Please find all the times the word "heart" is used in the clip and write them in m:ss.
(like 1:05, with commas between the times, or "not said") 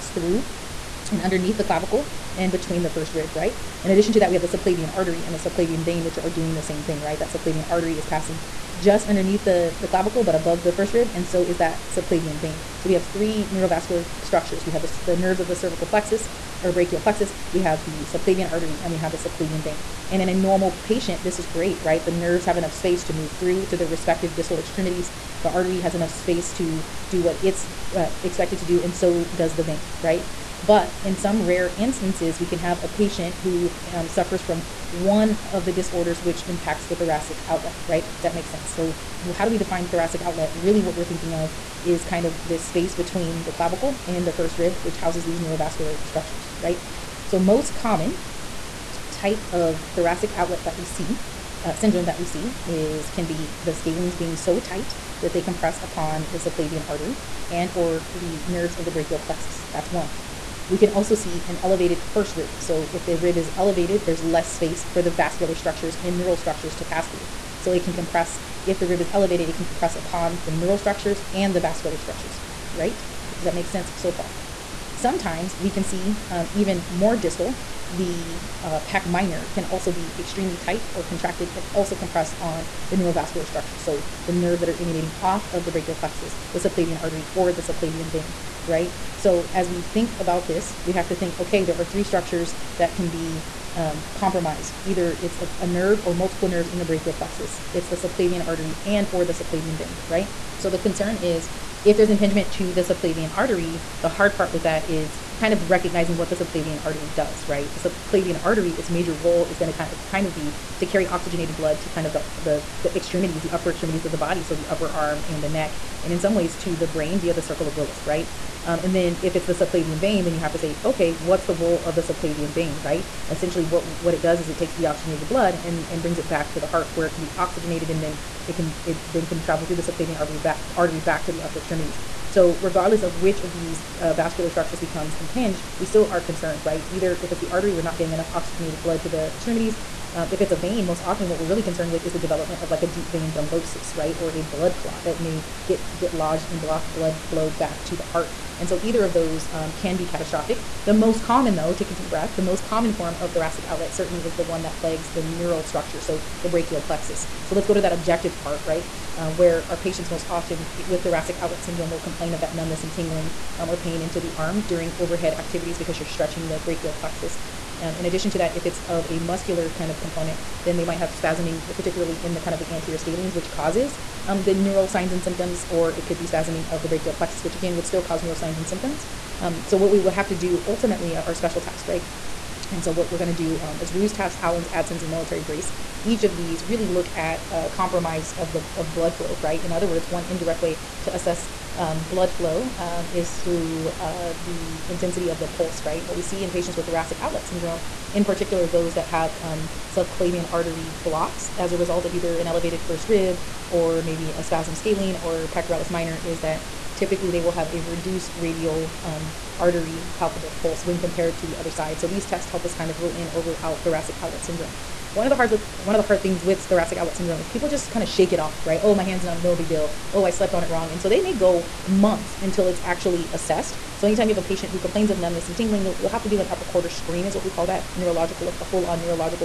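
2:06, 2:28.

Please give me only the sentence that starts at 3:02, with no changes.
And so what we're going to do um, is Roos, test, Allen's, Adson's, and military brace.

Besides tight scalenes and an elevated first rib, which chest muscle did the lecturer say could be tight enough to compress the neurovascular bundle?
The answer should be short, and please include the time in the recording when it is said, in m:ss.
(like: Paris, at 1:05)
Pec minor, at 1:18.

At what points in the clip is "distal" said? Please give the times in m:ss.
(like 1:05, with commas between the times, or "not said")
0:24, 1:17.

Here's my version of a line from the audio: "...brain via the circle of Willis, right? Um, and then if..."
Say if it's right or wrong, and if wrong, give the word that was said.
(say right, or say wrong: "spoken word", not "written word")
right.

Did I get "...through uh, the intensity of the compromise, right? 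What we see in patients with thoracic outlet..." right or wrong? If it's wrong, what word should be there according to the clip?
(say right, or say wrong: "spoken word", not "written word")
wrong: "pulse", not "compromise".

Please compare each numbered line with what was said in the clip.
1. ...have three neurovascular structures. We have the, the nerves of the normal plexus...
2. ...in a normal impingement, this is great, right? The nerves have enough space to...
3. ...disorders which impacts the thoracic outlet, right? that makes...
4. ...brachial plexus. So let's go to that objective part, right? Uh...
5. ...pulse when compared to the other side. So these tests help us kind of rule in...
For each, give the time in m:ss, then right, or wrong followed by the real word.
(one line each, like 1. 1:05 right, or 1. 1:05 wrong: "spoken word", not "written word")
1. 0:12 wrong: "cervical", not "normal"
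2. 0:20 wrong: "patient", not "impingement"
3. 0:35 right
4. 2:36 right
5. 3:30 right.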